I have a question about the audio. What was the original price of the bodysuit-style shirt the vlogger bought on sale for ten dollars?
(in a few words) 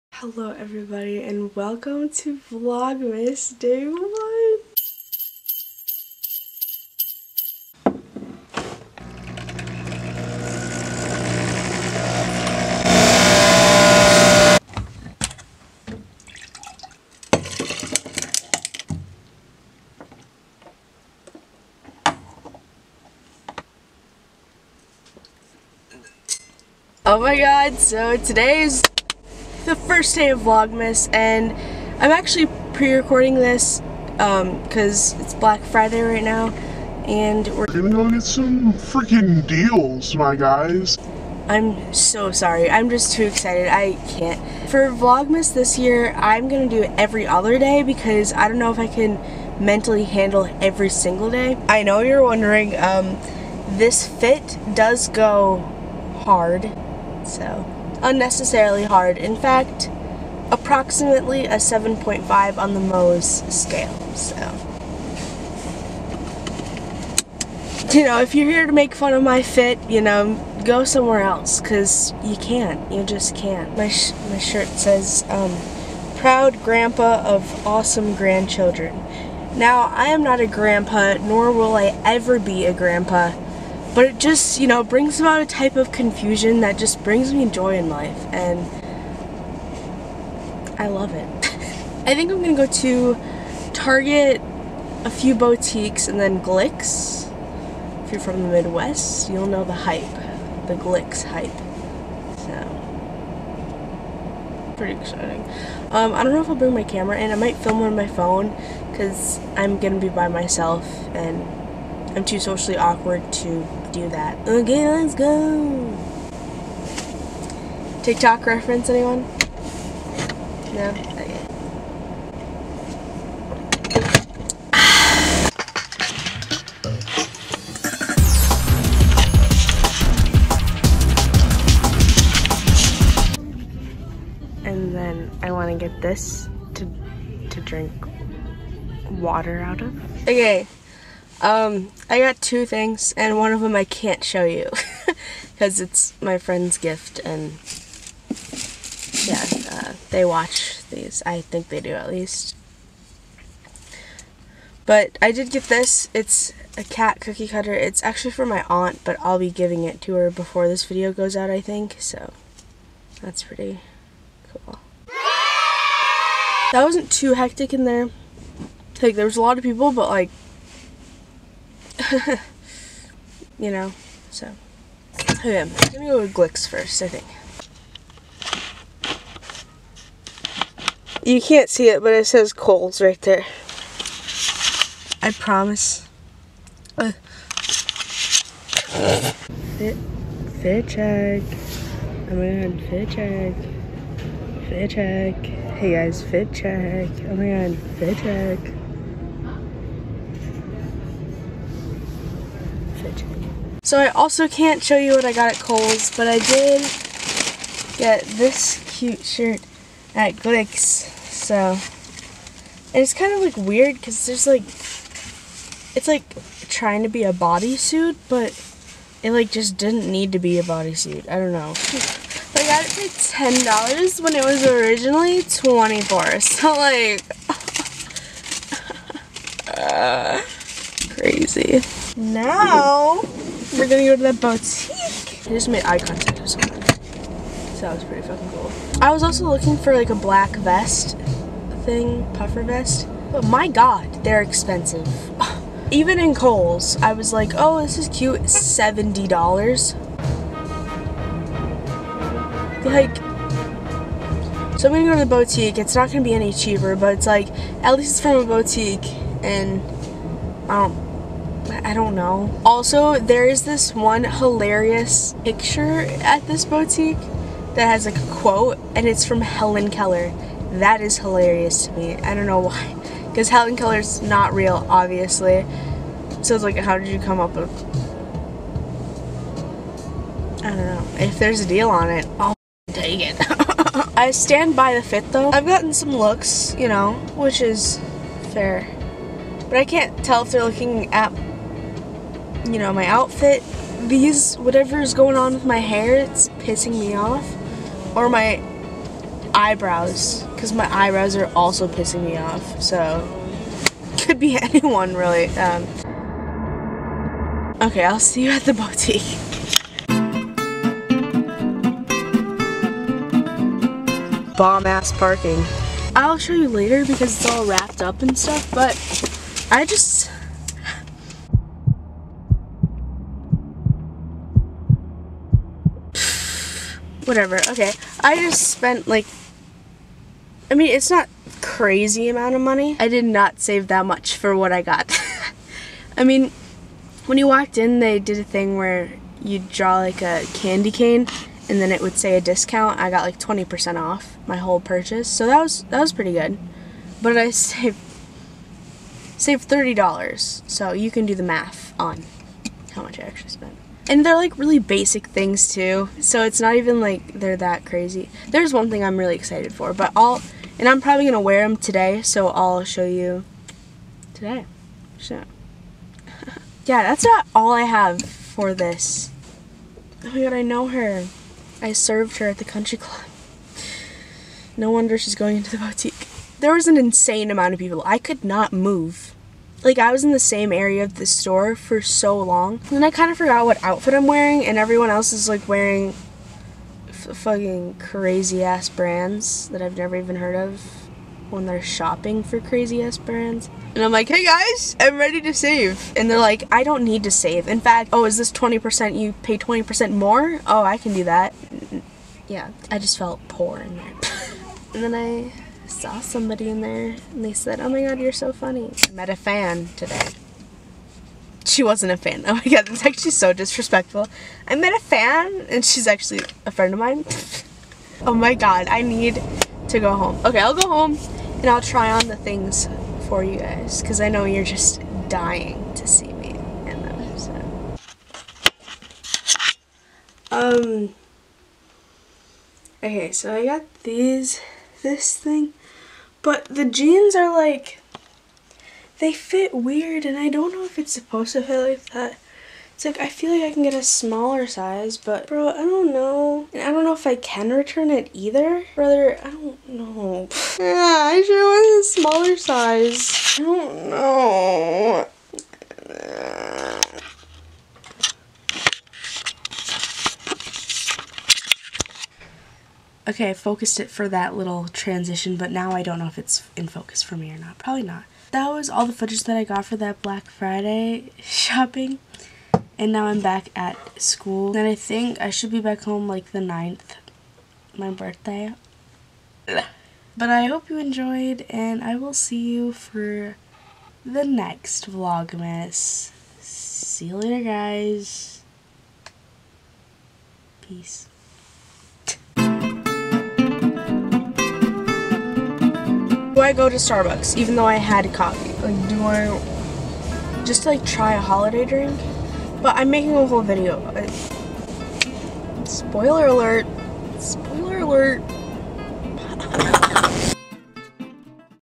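$24.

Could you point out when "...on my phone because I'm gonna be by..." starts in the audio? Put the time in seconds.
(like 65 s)
107 s.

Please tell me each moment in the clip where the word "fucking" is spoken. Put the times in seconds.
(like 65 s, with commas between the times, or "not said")
238 s, 387 s.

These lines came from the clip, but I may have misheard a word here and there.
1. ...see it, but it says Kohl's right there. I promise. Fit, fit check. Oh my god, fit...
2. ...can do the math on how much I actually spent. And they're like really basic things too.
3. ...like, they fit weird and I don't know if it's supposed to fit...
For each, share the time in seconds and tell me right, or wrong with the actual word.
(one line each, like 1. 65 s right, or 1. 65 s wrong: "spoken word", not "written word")
1. 181 s right
2. 351 s right
3. 437 s right.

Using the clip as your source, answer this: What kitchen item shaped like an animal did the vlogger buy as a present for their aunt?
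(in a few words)
cat cookie cutter.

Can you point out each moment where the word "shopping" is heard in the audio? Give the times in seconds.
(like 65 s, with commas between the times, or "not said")
391 s, 471 s.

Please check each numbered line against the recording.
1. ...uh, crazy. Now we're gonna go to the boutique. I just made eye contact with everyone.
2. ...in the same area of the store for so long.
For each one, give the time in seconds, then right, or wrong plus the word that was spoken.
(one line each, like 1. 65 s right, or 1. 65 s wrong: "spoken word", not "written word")
1. 229 s wrong: "someone", not "everyone"
2. 380 s right.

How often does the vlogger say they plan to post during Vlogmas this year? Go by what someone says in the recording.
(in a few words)
every other day.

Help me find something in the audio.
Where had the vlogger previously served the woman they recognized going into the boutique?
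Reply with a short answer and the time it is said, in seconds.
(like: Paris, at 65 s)
the country club, at 372 s.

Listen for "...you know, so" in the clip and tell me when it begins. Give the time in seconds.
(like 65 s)
173 s.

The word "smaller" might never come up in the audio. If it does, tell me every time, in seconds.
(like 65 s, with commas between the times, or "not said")
444 s, 452 s.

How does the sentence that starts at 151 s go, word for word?
I think they do at least.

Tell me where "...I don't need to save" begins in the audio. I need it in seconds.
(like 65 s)
396 s.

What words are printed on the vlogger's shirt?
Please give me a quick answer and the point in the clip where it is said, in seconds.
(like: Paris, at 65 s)
proud grandpa of awesome grandchildren, at 76 s.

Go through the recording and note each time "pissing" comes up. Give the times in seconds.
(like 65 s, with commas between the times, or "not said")
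296 s, 301 s.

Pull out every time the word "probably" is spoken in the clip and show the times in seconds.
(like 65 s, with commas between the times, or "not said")
360 s, 467 s.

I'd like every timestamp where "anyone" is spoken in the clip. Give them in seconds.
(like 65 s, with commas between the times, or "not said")
118 s, 304 s.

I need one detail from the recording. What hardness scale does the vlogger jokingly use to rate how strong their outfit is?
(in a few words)
Mohs scale.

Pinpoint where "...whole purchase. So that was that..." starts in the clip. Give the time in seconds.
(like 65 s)
344 s.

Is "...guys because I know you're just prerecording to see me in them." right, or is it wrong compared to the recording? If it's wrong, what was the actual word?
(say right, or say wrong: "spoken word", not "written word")
wrong: "dying", not "prerecording".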